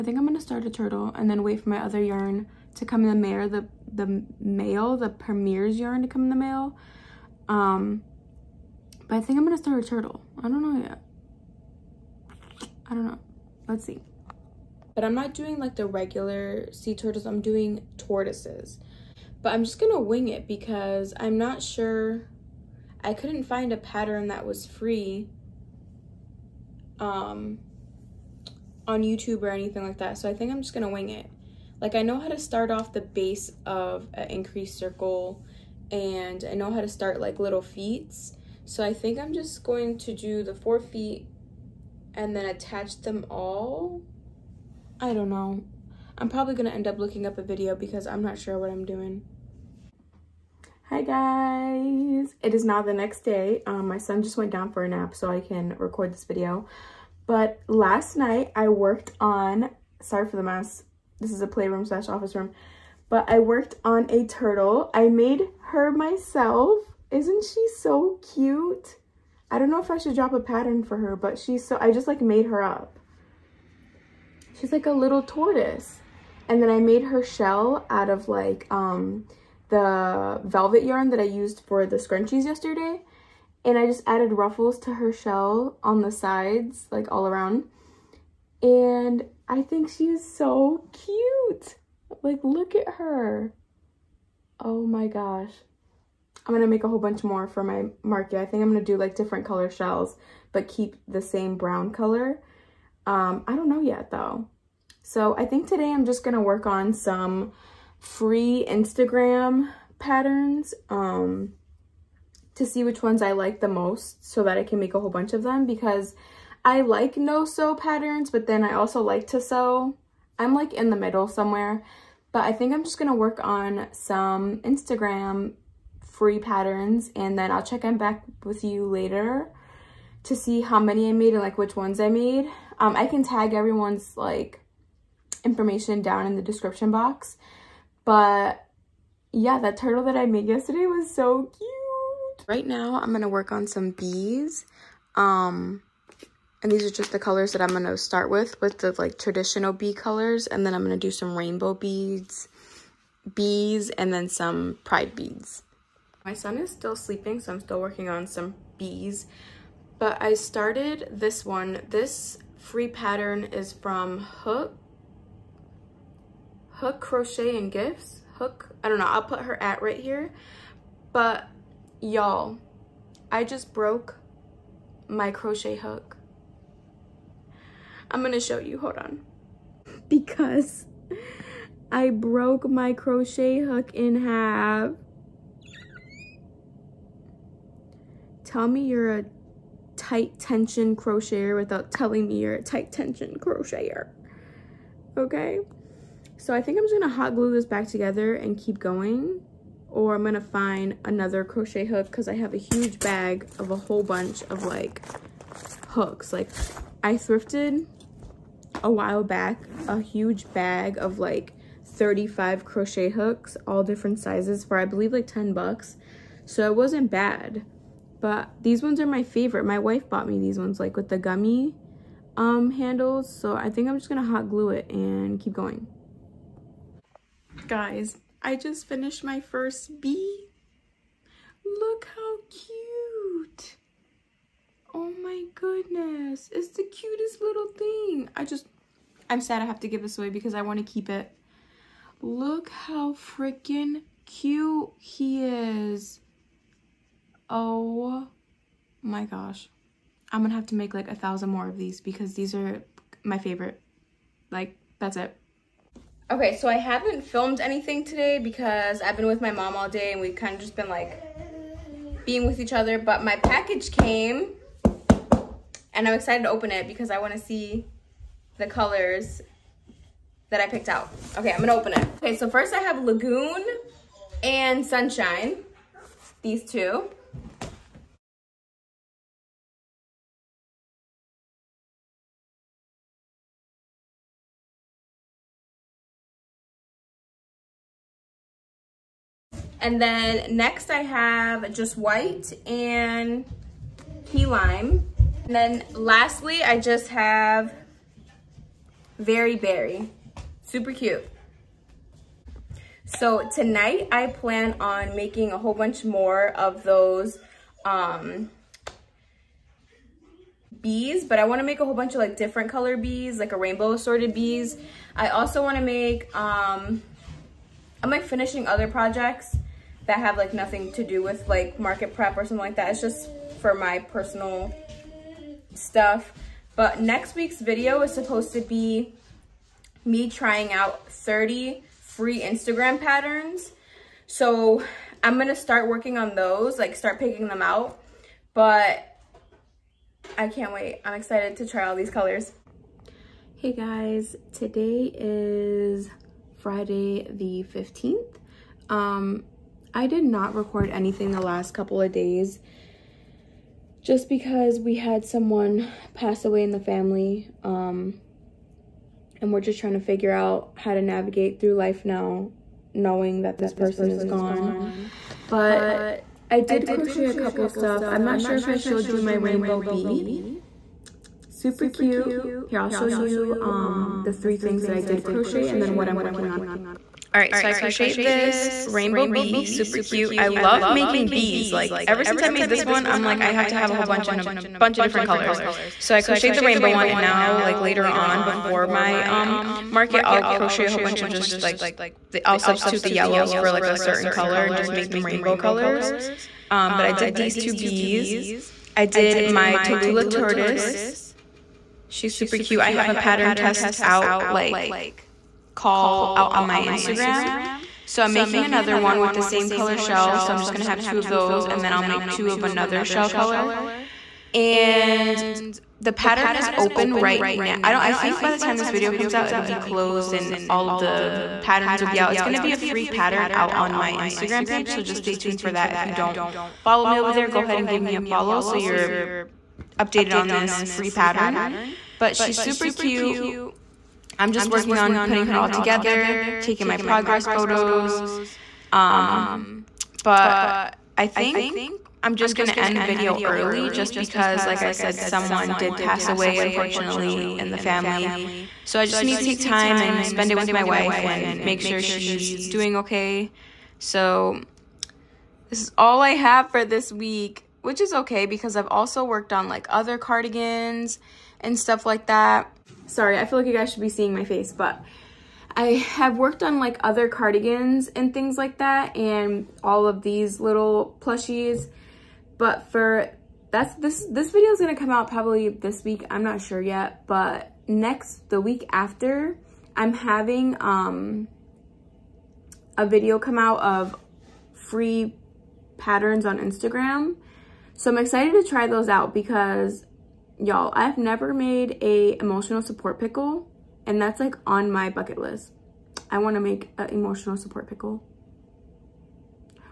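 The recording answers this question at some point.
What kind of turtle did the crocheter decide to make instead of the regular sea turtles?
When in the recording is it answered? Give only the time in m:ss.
0:17.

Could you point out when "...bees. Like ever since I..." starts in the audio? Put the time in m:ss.
6:21.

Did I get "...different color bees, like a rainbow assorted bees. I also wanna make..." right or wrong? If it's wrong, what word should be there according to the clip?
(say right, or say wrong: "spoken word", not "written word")
right.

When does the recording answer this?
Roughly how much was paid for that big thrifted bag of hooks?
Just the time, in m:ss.
3:35.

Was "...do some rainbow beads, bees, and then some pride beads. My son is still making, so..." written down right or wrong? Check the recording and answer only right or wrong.
wrong.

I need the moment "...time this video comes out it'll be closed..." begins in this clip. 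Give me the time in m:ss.
6:58.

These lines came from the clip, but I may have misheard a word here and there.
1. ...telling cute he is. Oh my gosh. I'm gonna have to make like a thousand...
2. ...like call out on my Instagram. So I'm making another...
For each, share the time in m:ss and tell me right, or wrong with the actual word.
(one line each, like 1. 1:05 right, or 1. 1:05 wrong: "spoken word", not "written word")
1. 4:03 wrong: "freaking", not "telling"
2. 6:44 right.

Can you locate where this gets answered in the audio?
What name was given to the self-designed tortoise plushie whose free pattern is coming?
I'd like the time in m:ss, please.
6:39.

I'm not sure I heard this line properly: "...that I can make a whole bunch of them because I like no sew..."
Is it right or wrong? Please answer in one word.
right.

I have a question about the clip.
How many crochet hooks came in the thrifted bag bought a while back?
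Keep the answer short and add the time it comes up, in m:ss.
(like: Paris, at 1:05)
35, at 3:31.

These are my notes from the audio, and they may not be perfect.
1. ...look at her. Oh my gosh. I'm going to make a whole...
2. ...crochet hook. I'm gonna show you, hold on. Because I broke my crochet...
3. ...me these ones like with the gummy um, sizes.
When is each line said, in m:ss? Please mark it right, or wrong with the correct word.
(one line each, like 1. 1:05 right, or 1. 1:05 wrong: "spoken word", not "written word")
1. 1:32 right
2. 2:55 right
3. 3:40 wrong: "handles", not "sizes".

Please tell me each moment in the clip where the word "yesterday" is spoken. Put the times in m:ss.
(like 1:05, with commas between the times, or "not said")
1:22, 2:20.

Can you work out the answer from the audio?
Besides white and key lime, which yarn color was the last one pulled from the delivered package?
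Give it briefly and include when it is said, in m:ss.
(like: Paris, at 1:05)
Very berry, at 4:59.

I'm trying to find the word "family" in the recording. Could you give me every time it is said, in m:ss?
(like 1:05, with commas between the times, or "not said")
5:56, 7:27.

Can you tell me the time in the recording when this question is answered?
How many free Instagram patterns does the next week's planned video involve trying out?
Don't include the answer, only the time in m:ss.
5:31.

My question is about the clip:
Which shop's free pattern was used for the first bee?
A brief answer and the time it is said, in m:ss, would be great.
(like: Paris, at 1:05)
Hook Crochet and Gifts, at 2:46.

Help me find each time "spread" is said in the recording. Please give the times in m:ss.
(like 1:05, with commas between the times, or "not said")
not said.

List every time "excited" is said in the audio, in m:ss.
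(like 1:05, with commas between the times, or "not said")
4:26, 5:41, 8:08.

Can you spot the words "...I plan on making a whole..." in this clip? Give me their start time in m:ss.
5:04.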